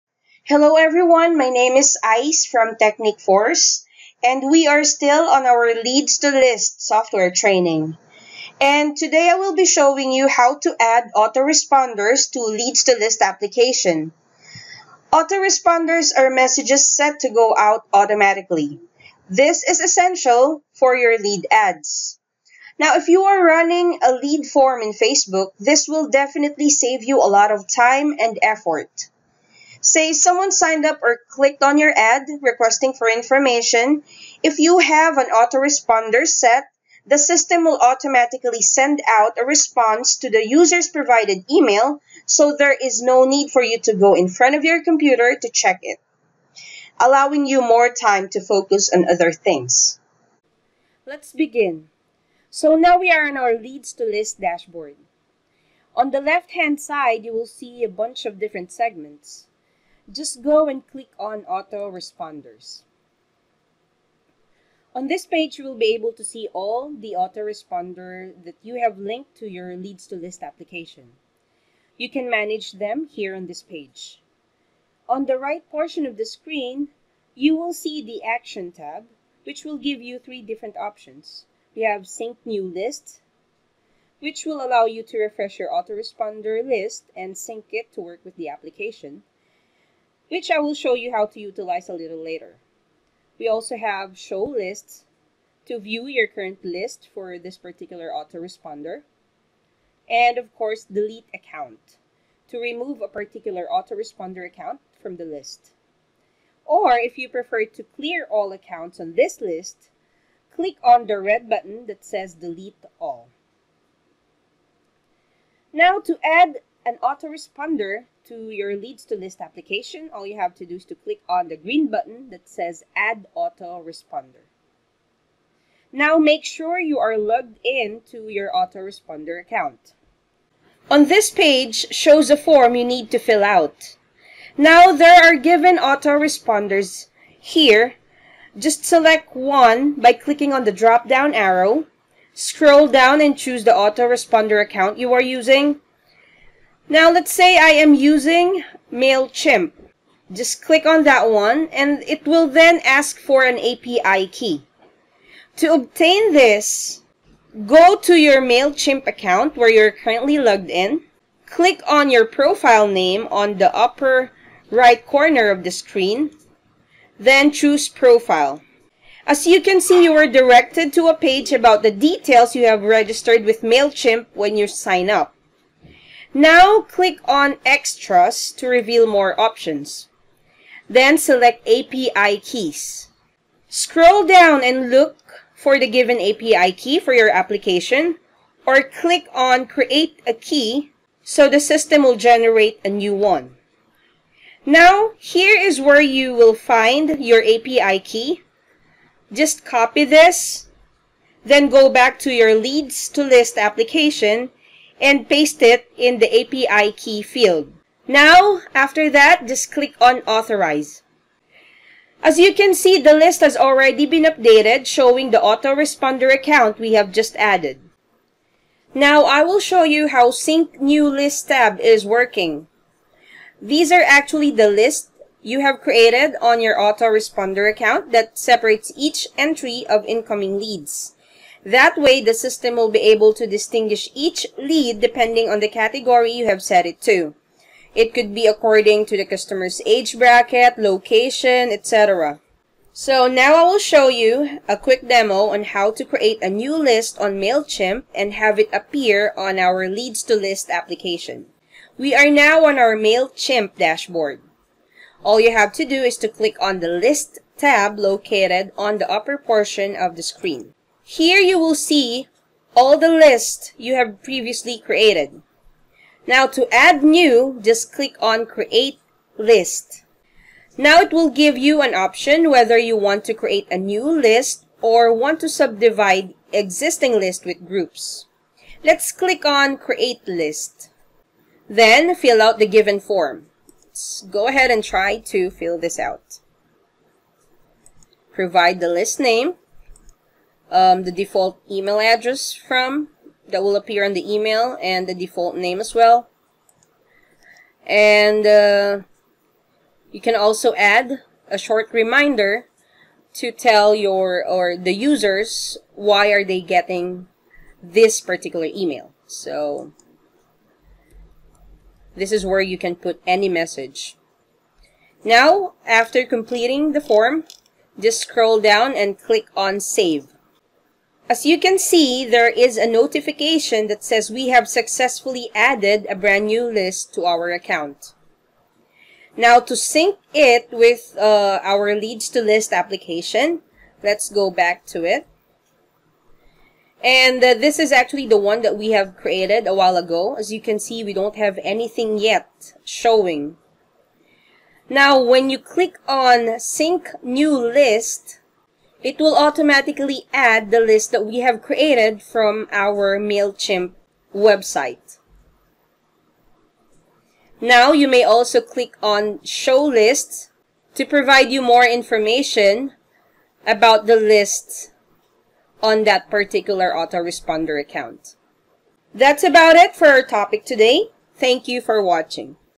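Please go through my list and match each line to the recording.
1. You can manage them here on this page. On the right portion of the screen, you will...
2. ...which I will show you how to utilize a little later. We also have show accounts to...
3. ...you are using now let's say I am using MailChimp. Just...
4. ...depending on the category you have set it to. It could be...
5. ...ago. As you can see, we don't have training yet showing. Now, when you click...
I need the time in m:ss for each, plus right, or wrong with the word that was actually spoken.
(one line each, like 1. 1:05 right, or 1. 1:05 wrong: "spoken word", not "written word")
1. 1:11 right
2. 1:30 wrong: "lists", not "accounts"
3. 2:24 right
4. 3:54 right
5. 5:39 wrong: "anything", not "training".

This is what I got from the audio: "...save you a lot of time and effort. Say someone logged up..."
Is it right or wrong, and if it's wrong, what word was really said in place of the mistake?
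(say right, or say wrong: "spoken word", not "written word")
wrong: "signed", not "logged".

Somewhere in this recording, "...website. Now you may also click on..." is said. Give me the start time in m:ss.
5:54.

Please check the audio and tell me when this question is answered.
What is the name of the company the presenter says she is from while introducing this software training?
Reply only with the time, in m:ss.
0:02.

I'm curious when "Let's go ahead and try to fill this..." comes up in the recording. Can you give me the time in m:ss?
4:43.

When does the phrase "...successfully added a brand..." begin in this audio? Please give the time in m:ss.
5:24.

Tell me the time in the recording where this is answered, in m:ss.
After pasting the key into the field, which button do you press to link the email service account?
3:30.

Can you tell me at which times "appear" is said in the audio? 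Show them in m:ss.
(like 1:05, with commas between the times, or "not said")
4:08, 4:53.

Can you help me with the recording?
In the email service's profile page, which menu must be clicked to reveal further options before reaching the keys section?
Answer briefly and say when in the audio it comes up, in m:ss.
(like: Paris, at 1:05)
Extras, at 2:57.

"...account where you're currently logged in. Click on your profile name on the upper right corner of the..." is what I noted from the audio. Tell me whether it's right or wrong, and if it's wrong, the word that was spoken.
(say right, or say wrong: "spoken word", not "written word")
right.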